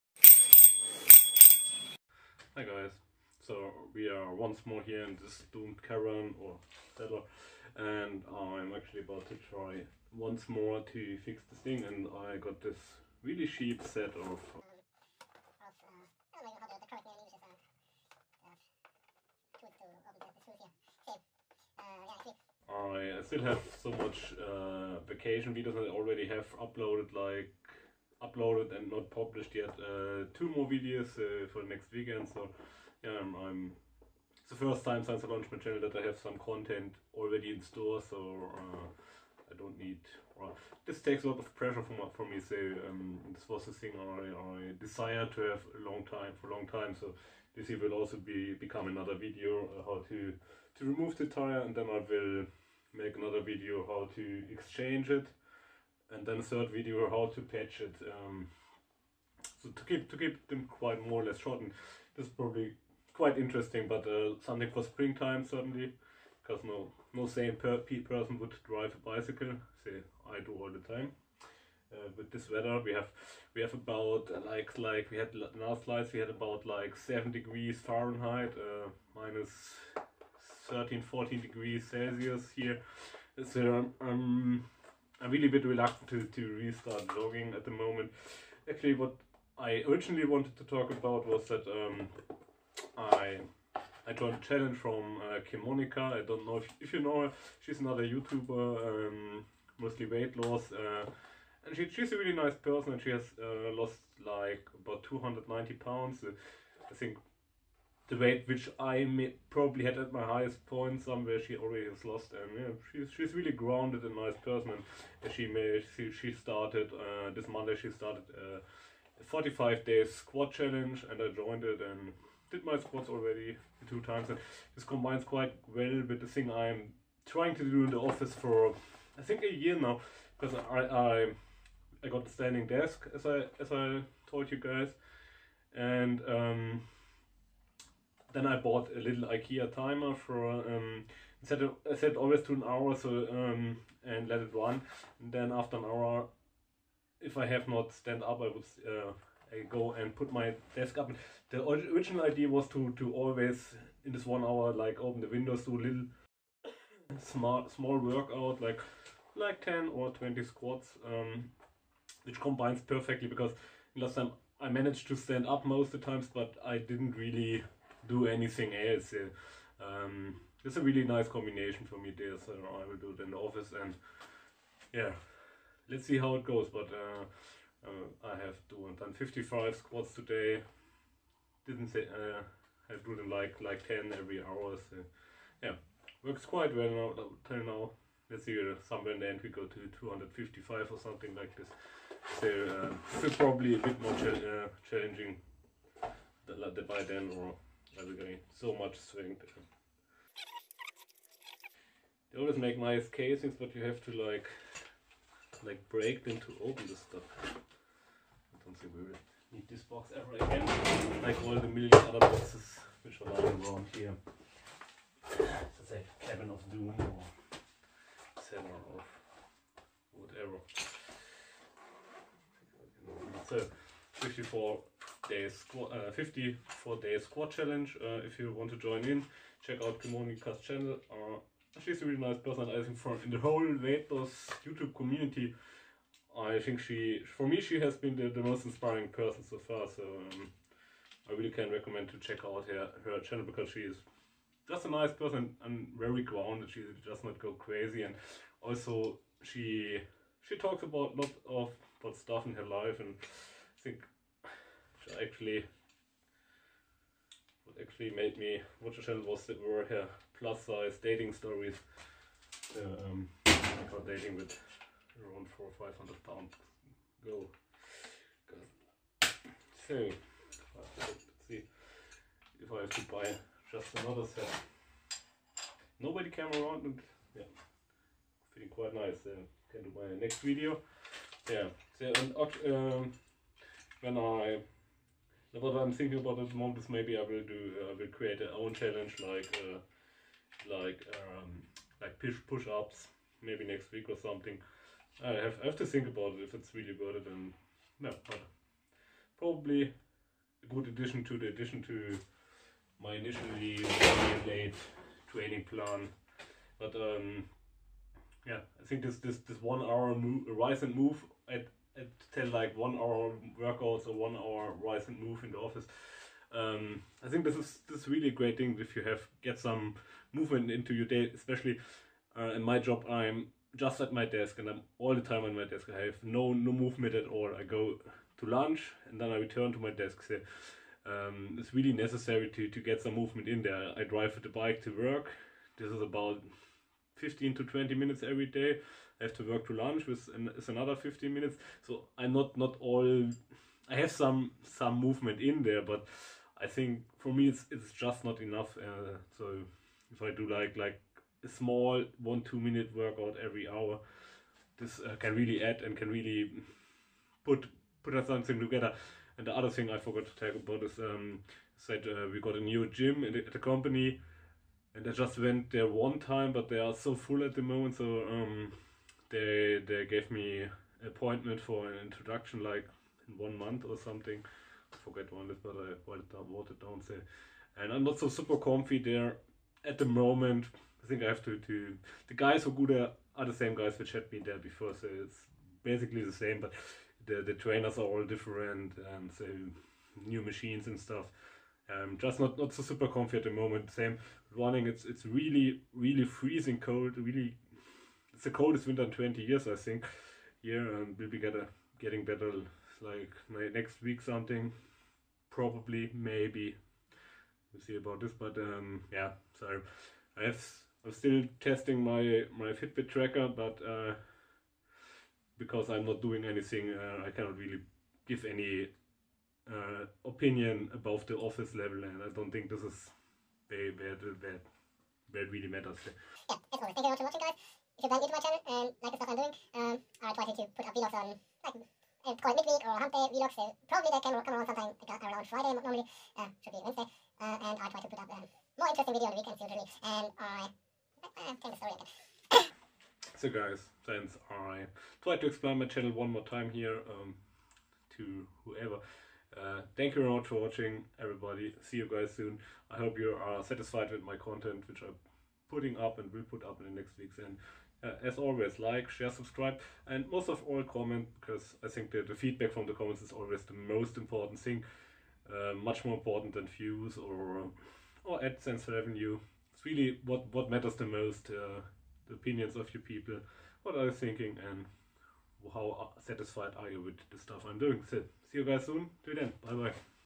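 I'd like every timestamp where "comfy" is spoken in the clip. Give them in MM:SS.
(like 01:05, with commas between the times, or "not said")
06:18, 06:33.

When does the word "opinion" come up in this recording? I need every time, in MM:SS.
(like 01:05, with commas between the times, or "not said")
07:00, 07:52.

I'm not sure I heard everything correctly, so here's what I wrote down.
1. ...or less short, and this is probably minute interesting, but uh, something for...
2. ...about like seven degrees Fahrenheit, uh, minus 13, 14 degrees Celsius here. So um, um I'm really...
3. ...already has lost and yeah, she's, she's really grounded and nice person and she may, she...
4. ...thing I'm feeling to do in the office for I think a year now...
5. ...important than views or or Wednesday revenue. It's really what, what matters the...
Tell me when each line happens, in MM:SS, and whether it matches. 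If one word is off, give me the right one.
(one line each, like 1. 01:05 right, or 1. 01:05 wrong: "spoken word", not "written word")
1. 01:01 wrong: "quite", not "minute"
2. 01:16 right
3. 01:51 right
4. 02:06 wrong: "trying", not "feeling"
5. 07:46 wrong: "AdSense", not "Wednesday".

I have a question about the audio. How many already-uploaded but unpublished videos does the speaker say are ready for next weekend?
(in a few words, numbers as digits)
2.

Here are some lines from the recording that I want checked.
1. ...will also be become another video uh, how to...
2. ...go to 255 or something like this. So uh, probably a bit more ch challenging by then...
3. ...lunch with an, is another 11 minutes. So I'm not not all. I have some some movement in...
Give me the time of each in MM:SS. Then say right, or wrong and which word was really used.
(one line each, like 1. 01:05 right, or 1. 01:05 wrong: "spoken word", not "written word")
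1. 00:47 right
2. 03:09 right
3. 05:39 wrong: "15", not "11".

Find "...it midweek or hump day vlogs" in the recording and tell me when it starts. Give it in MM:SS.
07:12.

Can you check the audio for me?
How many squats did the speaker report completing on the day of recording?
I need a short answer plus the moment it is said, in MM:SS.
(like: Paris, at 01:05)
55, at 02:59.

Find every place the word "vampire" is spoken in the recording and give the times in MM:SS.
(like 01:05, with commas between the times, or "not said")
not said.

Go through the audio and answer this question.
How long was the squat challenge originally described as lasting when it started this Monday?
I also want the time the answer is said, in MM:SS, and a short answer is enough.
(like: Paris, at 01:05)
45 days, at 01:59.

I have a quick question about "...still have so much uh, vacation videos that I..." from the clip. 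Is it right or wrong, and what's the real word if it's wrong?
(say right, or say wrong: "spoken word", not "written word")
right.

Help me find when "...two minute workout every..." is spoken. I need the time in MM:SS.
05:52.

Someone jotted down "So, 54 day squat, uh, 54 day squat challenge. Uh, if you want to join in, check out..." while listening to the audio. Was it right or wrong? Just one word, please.
right.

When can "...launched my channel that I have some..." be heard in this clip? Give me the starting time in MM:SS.
00:35.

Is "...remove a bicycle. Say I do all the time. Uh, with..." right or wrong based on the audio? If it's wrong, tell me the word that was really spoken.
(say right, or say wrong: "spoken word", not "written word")
wrong: "drive", not "remove".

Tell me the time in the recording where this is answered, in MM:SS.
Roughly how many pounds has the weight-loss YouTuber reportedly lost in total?
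01:45.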